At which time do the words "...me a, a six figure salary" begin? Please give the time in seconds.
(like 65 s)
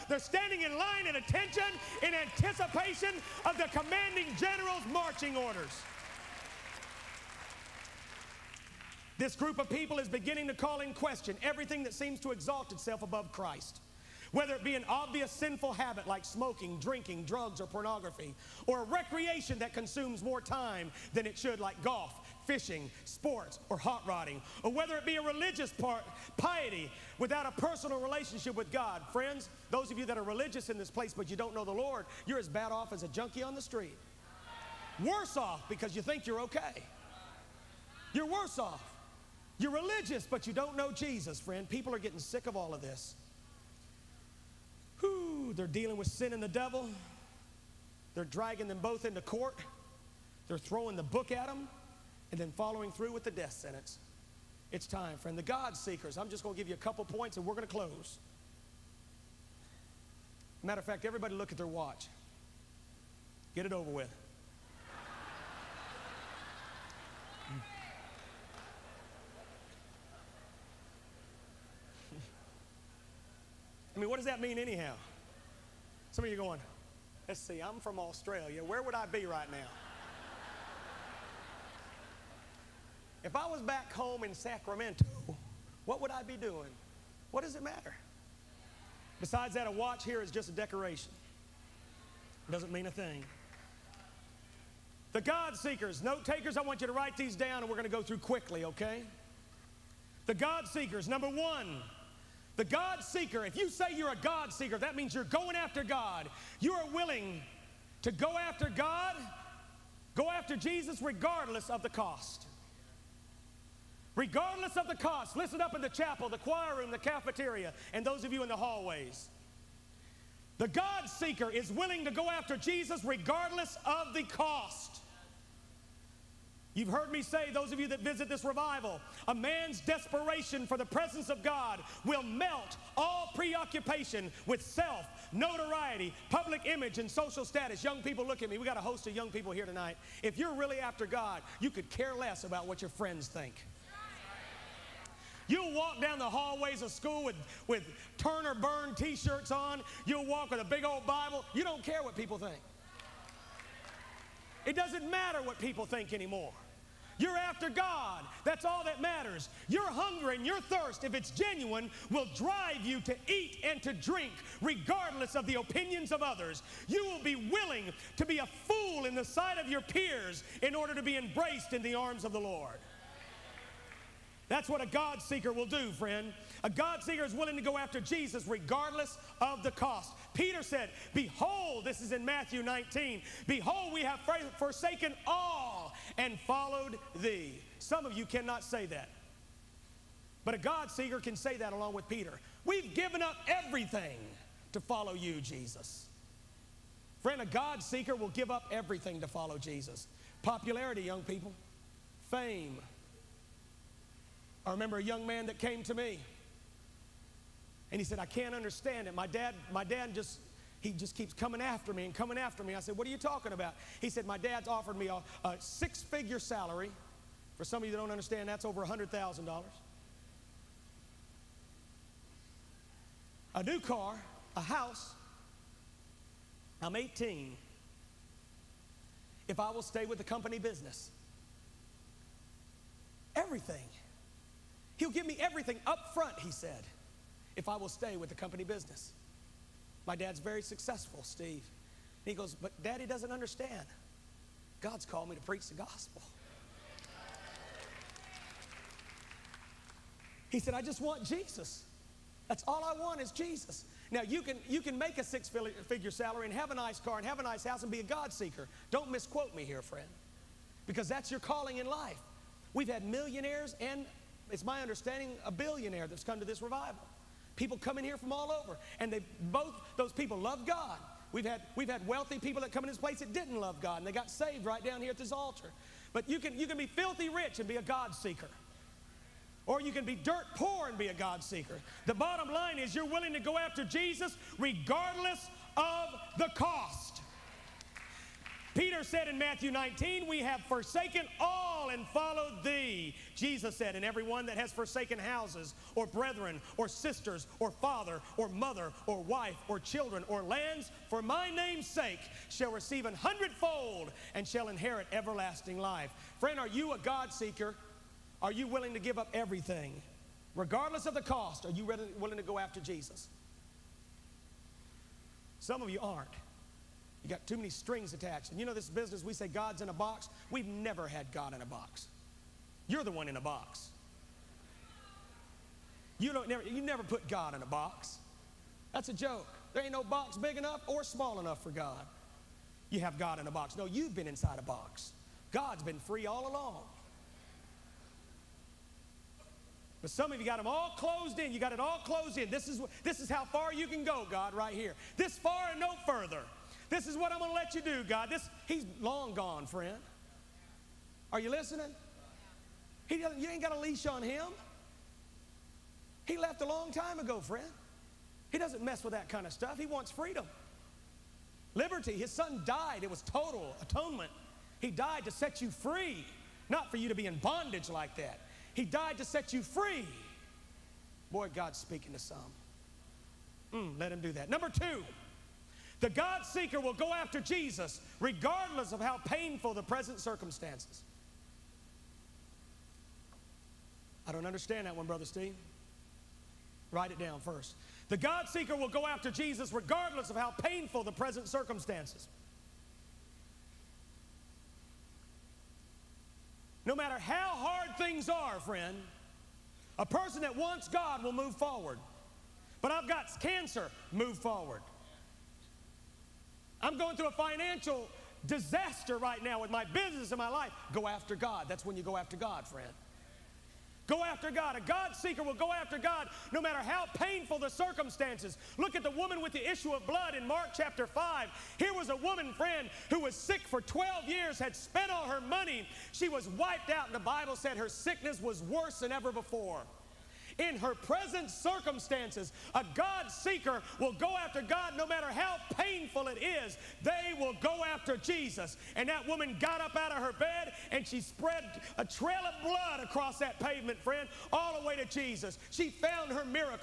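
214 s.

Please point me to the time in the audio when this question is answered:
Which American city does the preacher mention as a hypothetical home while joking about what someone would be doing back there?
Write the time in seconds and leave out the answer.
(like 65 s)
84 s.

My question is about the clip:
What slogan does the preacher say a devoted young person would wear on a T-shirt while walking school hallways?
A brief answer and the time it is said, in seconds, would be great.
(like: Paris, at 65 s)
Turn or Burn, at 148 s.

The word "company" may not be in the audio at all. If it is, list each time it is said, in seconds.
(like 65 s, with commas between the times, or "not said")
230 s, 238 s.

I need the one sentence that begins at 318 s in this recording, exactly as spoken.
And you know this business, we say God's in a box.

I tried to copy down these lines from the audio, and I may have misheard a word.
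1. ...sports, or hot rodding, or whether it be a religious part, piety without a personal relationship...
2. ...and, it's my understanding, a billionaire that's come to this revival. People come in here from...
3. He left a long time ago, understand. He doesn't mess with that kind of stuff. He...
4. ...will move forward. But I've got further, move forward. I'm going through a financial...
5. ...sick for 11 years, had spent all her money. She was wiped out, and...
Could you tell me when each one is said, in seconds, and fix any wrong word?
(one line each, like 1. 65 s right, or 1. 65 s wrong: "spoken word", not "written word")
1. 23 s right
2. 263 s right
3. 356 s wrong: "friend", not "understand"
4. 401 s wrong: "cancer", not "further"
5. 423 s wrong: "12", not "11".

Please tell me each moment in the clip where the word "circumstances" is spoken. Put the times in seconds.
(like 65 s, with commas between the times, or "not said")
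380 s, 391 s, 417 s, 431 s.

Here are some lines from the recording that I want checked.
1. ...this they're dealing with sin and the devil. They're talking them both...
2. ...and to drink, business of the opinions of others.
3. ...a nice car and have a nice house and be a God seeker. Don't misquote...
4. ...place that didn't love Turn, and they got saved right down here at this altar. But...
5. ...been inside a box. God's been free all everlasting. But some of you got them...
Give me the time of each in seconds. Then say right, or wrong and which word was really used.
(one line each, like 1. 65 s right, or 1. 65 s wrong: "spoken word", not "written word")
1. 42 s wrong: "dragging", not "talking"
2. 163 s wrong: "regardless", not "business"
3. 256 s right
4. 272 s wrong: "God", not "Turn"
5. 334 s wrong: "along", not "everlasting".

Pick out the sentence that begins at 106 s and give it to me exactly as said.
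You are willing to go after God, go after Jesus, regardless of the cost.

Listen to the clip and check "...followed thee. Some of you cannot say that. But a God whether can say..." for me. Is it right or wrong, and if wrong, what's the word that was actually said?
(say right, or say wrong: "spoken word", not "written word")
wrong: "seeker", not "whether".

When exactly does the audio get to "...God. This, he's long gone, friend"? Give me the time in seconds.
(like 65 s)
348 s.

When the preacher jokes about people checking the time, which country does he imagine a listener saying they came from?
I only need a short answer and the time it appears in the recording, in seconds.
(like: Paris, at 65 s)
Australia, at 77 s.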